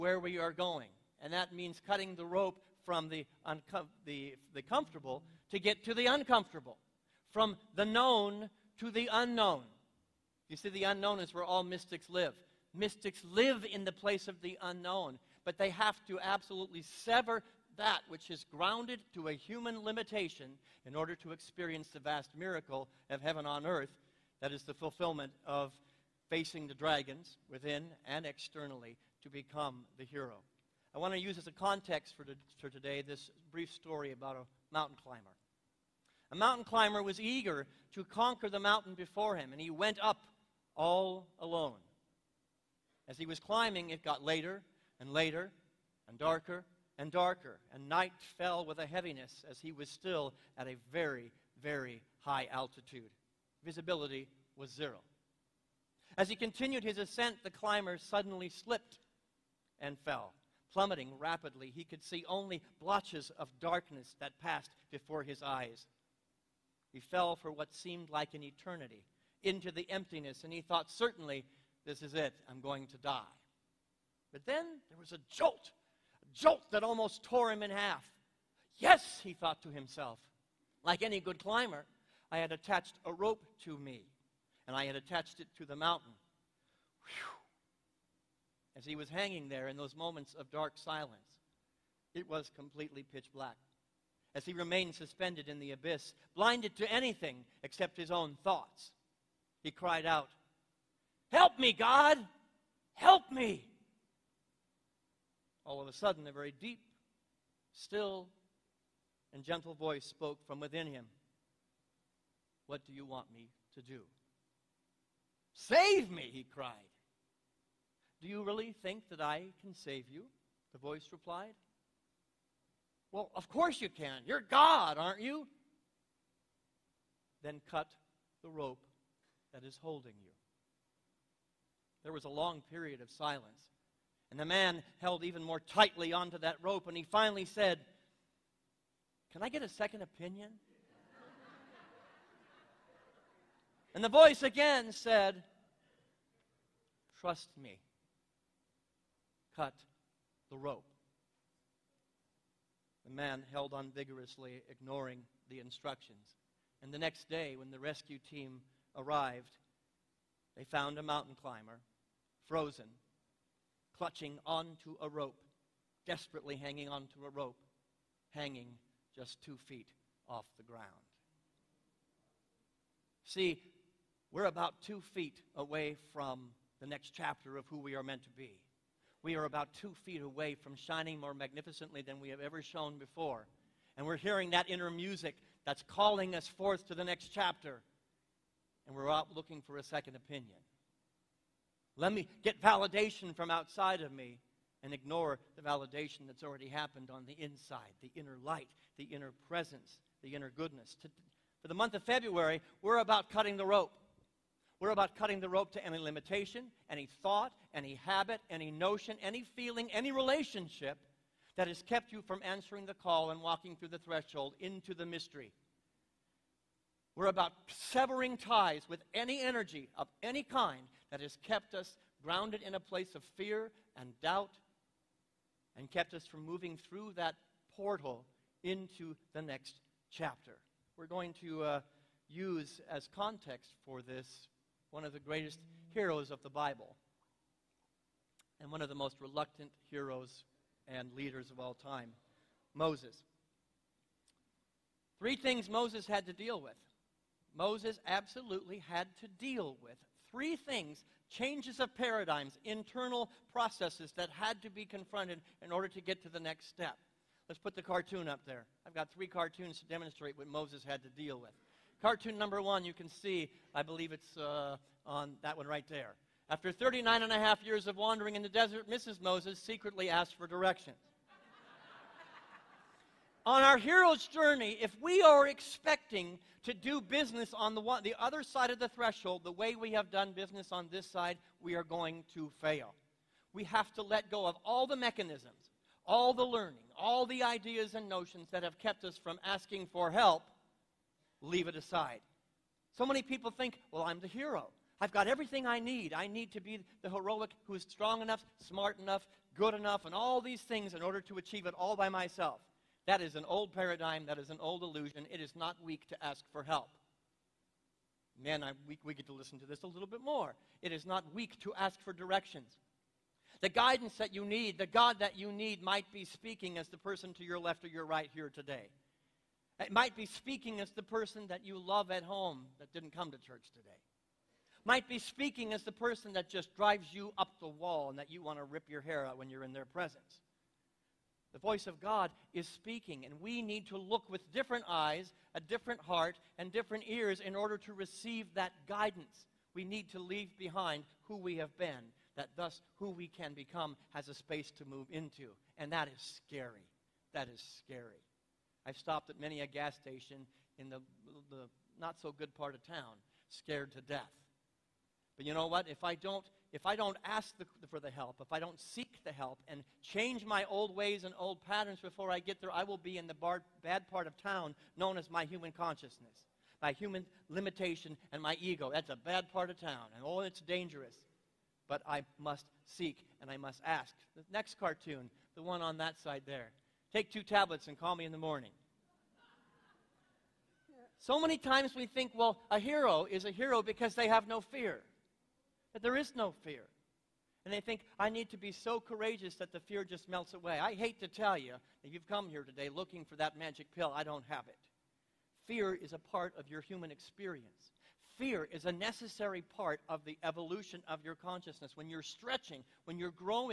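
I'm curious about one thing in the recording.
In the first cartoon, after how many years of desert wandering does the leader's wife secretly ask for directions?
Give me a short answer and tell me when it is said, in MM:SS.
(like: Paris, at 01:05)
39 and a half, at 04:26.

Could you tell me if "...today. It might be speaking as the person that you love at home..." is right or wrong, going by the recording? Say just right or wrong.
right.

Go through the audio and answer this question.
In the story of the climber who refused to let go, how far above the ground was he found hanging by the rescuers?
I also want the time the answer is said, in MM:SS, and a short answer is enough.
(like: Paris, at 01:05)
2 feet, at 02:49.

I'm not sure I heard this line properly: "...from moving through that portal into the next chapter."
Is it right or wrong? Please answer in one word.
right.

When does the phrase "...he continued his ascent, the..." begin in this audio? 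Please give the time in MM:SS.
00:56.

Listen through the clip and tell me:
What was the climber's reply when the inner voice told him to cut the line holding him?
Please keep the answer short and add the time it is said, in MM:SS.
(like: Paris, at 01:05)
Can I get a second opinion?, at 02:19.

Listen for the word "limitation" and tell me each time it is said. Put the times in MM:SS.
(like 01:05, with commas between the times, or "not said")
00:19, 03:25, 06:07.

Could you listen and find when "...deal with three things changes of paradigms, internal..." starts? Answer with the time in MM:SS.
04:09.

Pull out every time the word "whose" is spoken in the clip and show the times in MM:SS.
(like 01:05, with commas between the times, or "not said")
not said.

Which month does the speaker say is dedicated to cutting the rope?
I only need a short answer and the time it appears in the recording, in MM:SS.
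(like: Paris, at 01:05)
February, at 03:22.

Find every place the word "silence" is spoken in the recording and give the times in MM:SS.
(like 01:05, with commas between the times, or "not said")
01:30, 02:13.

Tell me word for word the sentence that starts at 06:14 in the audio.
The next cartoon, the one on that side there.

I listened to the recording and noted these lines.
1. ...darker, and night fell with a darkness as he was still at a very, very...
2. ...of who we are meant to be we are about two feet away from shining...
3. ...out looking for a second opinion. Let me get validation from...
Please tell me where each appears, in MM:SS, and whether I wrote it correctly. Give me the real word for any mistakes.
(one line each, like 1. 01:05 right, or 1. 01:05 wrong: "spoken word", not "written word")
1. 00:47 wrong: "heaviness", not "darkness"
2. 02:57 right
3. 03:09 right.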